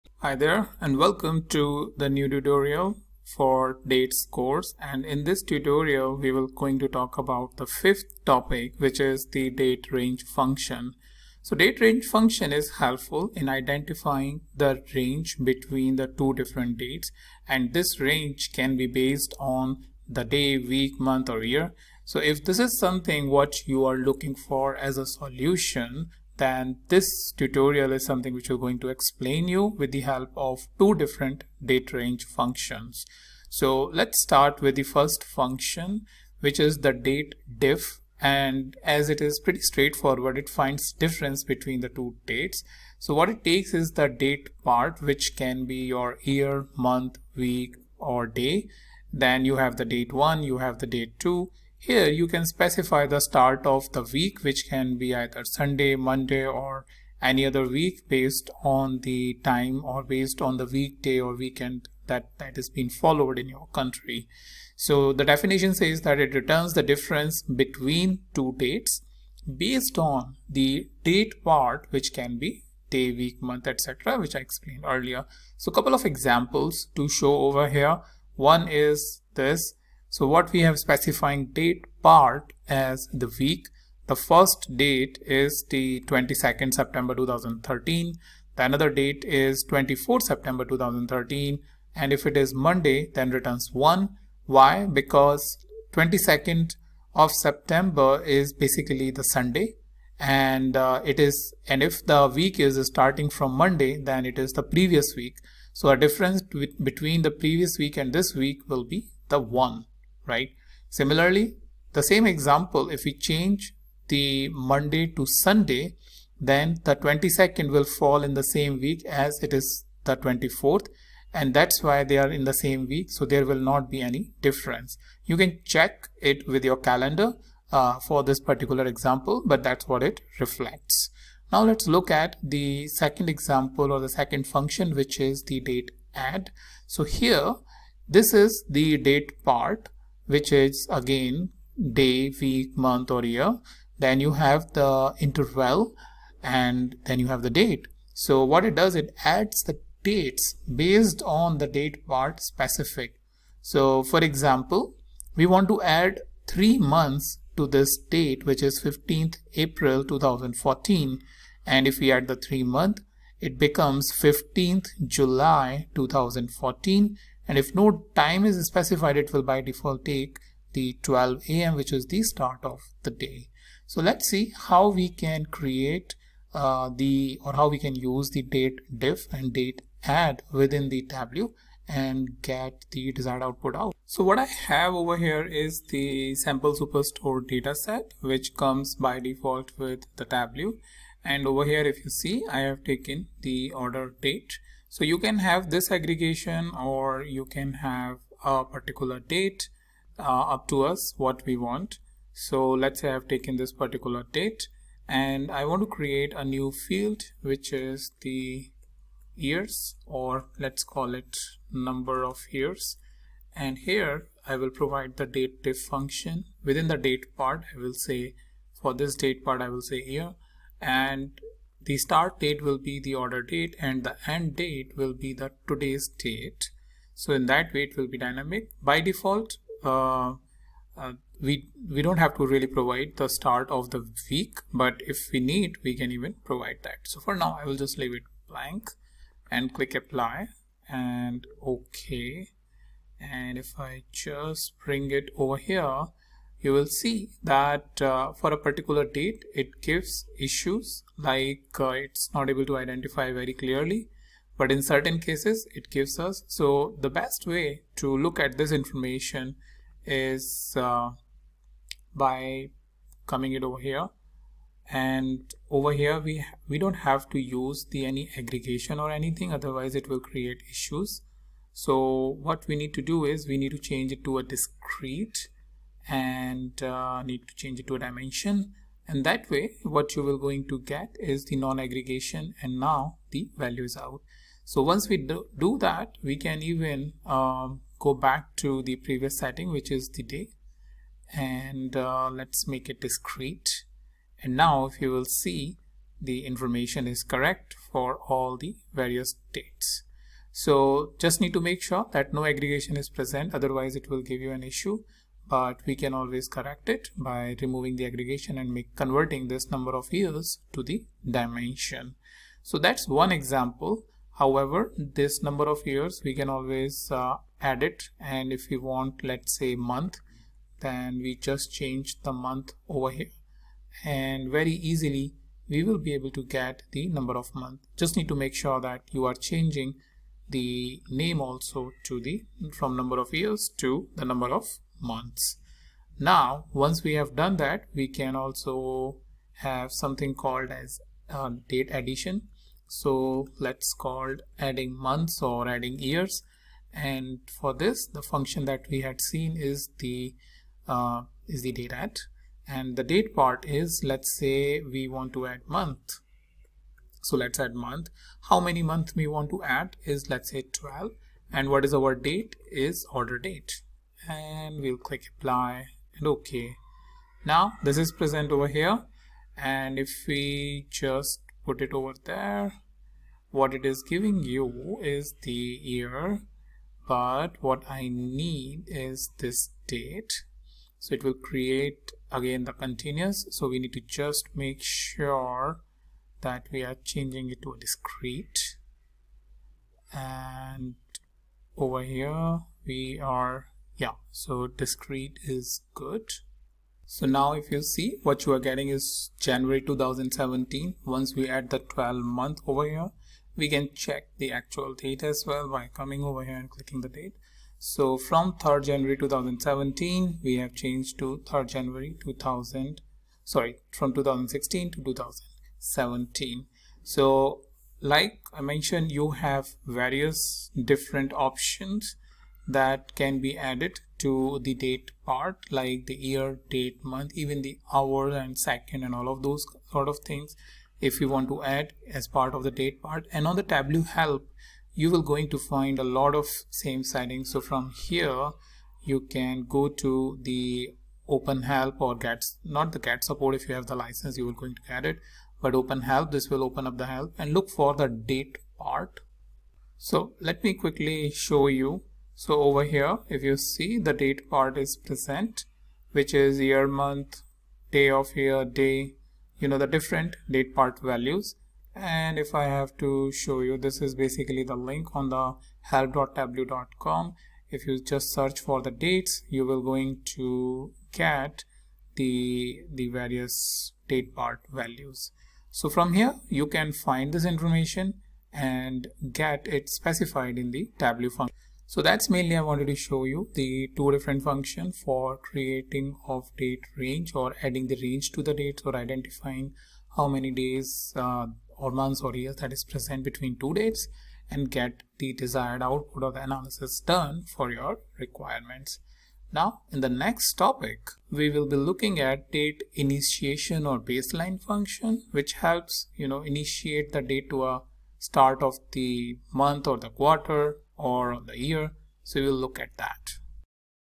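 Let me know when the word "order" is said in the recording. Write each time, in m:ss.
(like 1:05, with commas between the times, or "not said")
3:13, 3:43, 6:03.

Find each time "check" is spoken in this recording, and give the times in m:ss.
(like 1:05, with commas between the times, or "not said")
2:05, 6:43.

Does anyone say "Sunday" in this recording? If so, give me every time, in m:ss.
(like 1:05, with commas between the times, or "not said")
0:55, 1:39, 1:55.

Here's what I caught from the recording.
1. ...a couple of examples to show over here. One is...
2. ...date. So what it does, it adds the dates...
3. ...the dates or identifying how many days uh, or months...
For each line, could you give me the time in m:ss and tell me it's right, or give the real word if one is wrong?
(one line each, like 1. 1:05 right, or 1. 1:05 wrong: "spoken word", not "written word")
1. 1:15 right
2. 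2:27 right
3. 8:08 right.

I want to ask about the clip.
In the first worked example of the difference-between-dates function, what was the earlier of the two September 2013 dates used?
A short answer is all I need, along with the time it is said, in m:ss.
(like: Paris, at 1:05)
22nd September 2013, at 1:26.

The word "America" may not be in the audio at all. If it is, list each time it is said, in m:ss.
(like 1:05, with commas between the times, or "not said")
not said.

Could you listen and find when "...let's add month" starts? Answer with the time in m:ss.
5:57.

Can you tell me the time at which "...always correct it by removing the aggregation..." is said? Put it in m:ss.
5:06.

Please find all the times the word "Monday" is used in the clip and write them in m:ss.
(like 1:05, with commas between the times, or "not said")
0:55, 1:32, 1:43, 1:54.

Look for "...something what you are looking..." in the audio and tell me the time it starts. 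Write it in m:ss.
0:22.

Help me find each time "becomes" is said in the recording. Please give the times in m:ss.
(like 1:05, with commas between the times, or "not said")
2:43.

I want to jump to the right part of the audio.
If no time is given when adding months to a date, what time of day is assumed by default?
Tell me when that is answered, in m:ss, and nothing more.
2:51.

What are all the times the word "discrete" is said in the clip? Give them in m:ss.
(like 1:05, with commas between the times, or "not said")
4:34, 4:53, 6:27, 6:34.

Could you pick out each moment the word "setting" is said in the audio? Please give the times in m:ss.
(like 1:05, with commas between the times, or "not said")
4:49, 7:17.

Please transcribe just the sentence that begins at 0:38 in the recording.
And as it is pretty straightforward, it finds difference between the two dates.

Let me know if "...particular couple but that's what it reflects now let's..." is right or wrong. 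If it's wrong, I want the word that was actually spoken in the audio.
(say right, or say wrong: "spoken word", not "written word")
wrong: "example", not "couple".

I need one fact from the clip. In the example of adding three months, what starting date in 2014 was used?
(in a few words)
15th April 2014.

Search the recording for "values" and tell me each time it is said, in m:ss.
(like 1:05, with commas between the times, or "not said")
4:43, 7:41, 7:54.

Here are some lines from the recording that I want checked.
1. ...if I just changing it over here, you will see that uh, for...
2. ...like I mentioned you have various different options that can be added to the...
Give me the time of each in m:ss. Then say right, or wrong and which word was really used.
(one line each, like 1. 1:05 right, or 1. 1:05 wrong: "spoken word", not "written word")
1. 4:03 wrong: "bring", not "changing"
2. 6:57 right.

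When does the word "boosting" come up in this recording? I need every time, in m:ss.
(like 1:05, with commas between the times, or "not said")
not said.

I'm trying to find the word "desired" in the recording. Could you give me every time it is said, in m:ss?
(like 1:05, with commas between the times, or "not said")
3:03, 8:15.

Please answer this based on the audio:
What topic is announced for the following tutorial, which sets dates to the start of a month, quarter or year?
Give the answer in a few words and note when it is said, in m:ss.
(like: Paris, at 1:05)
date initiation, at 8:22.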